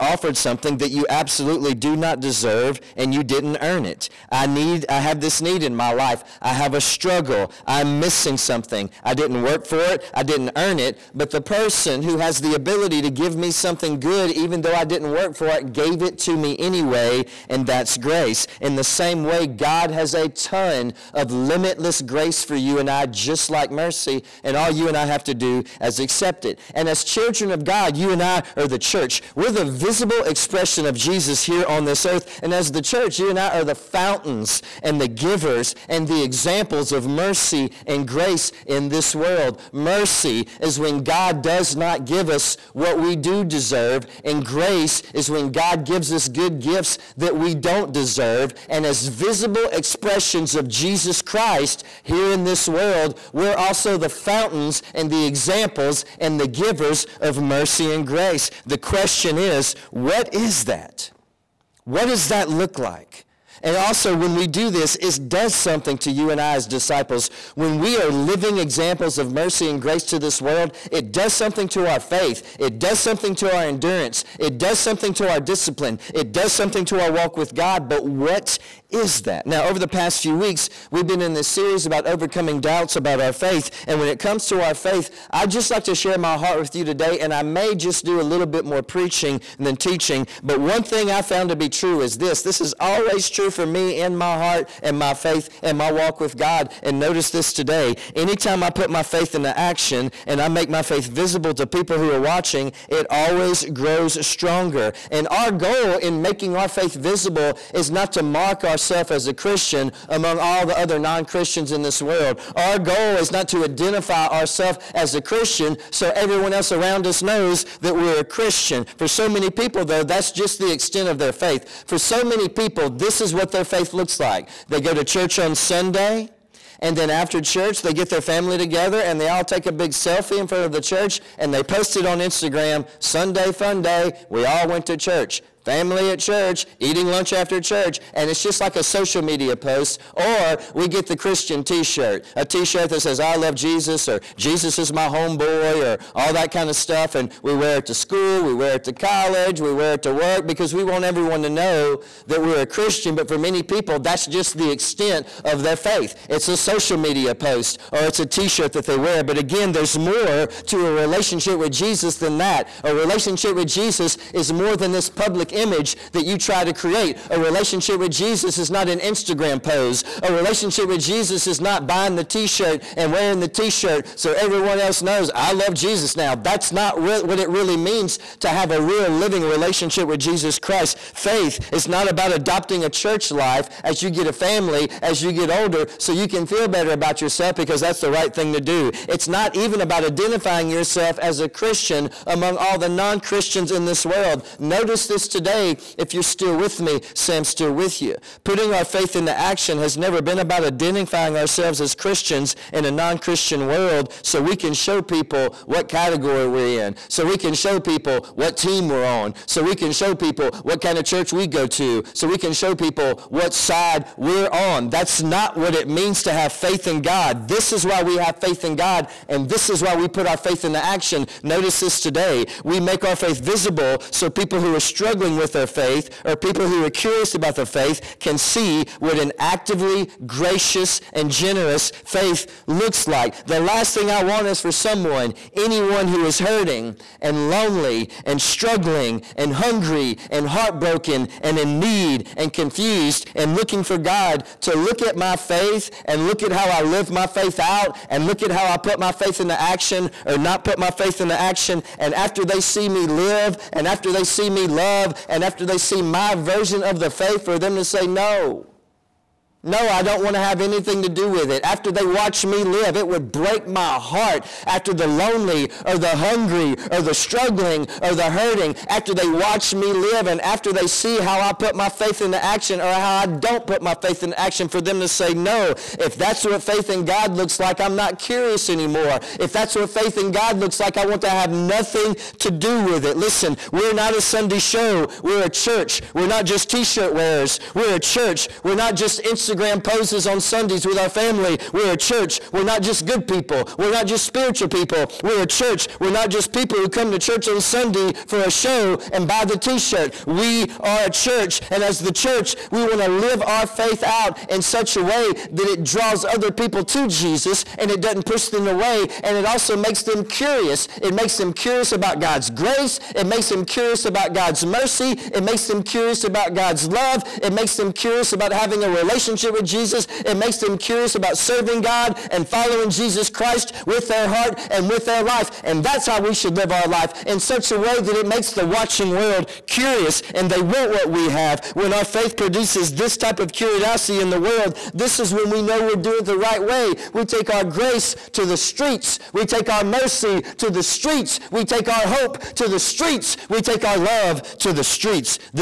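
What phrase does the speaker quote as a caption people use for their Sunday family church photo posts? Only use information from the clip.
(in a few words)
Sunday fun day.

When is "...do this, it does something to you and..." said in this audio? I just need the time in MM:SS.
01:04.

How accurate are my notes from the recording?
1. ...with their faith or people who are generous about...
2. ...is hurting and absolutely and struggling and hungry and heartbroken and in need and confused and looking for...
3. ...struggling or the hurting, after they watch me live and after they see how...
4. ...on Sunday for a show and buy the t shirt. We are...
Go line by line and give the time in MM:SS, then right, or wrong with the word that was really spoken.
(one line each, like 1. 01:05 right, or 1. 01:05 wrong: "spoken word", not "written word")
1. 03:45 wrong: "curious", not "generous"
2. 03:56 wrong: "lonely", not "absolutely"
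3. 04:27 right
4. 04:57 right.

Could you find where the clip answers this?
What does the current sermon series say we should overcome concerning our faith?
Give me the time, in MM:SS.
01:22.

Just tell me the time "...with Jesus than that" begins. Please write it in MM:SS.
02:41.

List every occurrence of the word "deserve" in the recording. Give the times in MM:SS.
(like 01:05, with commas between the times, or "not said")
00:02, 00:43, 00:47.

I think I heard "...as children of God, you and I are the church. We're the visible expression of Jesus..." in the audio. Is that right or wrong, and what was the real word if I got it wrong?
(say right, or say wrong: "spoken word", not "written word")
right.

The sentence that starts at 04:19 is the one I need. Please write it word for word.
No, I don't want to have anything to do with it.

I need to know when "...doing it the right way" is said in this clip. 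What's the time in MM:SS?
05:35.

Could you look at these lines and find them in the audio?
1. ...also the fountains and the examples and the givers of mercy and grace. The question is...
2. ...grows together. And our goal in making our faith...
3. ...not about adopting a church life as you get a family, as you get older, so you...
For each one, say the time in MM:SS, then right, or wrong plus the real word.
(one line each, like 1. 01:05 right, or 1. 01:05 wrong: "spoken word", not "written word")
1. 00:53 right
2. 01:43 wrong: "stronger", not "together"
3. 03:01 right.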